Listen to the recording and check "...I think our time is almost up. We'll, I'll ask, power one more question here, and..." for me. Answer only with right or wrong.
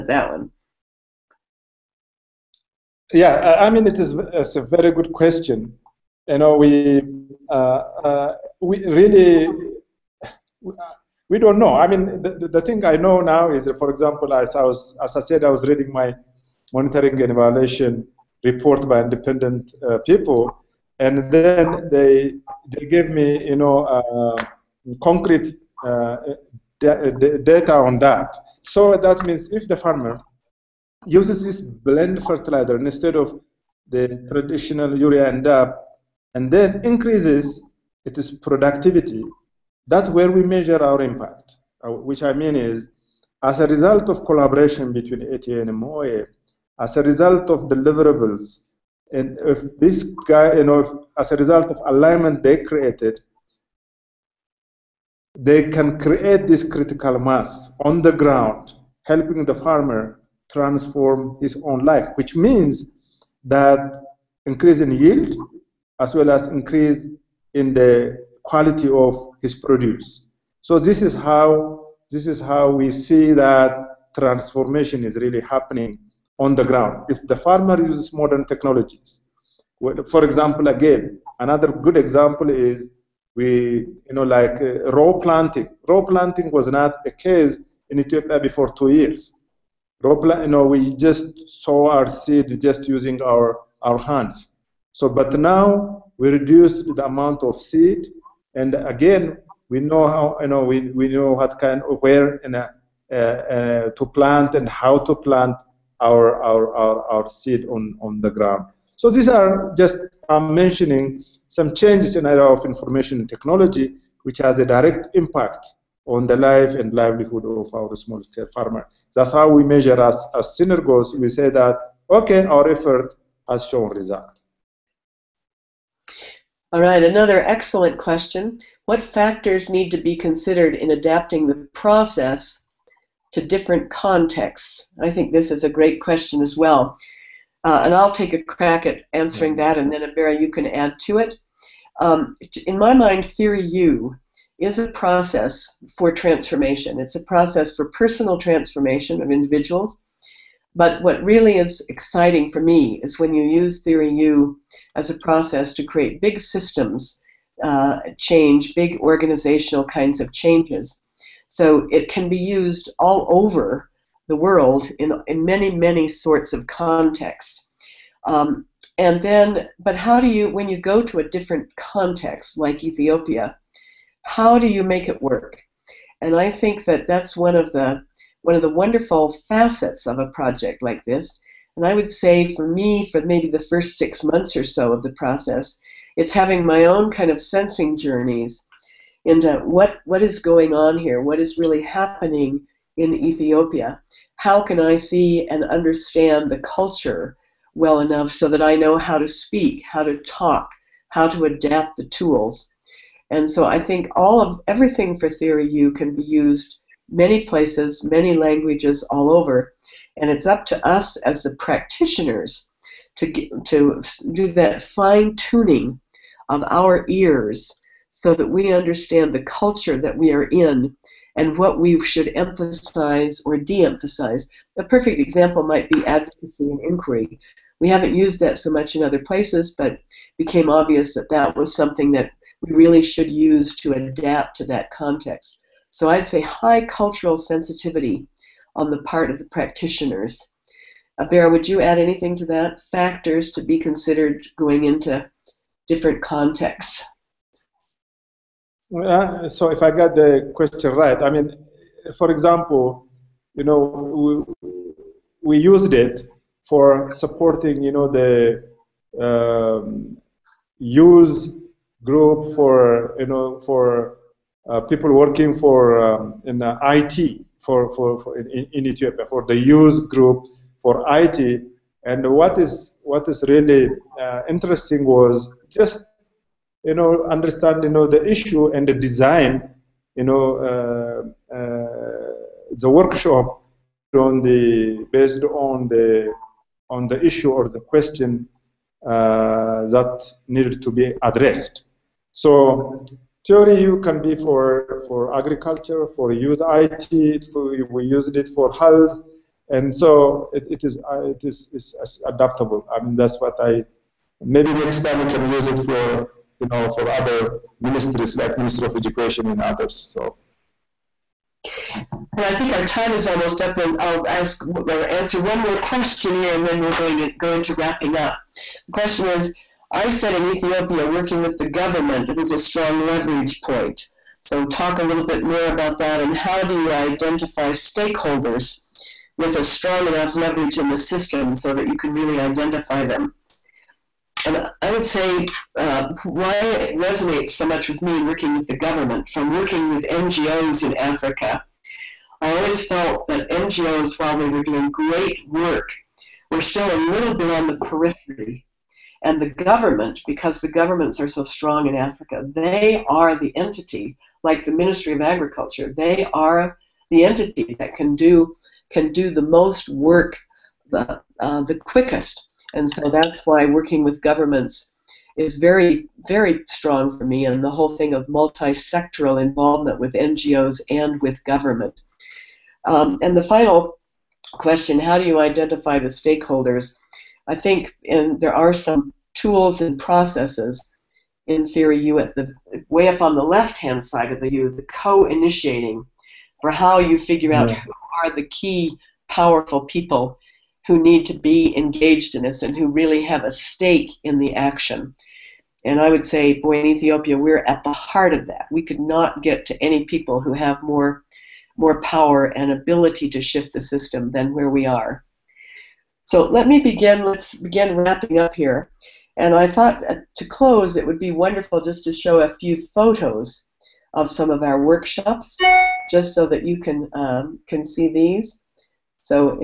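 wrong.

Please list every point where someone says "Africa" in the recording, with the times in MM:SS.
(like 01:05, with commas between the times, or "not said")
05:40, 05:51.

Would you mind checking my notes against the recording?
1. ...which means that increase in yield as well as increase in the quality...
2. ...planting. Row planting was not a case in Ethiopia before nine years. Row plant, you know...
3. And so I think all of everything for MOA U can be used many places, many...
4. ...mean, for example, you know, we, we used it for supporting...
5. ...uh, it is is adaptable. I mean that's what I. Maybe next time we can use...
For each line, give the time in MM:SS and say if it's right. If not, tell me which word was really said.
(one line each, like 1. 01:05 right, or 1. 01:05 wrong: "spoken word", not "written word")
1. 01:02 right
2. 01:25 wrong: "two", not "nine"
3. 03:23 wrong: "Theory", not "MOA"
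4. 04:11 right
5. 05:01 right.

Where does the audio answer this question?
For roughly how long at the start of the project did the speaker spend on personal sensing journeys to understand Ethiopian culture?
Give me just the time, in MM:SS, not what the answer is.
03:03.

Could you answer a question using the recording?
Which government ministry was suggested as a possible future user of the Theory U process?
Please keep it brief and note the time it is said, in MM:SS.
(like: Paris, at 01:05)
Ministry of Education, at 05:08.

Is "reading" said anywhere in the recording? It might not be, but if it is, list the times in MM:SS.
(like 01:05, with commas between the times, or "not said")
00:15.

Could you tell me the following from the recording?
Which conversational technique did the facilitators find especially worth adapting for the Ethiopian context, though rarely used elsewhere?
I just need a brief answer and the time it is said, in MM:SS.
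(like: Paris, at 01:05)
Advocacy and inquiry, at 03:46.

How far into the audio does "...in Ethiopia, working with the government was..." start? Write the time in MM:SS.
05:20.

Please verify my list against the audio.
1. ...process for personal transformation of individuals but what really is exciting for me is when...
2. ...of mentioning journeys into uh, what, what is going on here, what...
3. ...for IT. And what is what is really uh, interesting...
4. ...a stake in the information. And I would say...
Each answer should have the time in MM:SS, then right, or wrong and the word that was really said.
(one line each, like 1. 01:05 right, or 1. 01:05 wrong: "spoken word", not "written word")
1. 02:27 right
2. 03:07 wrong: "sensing", not "mentioning"
3. 04:30 right
4. 06:33 wrong: "action", not "information".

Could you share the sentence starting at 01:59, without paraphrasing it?
That's how we measure as, as synergos.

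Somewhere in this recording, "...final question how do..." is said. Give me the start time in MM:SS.
06:13.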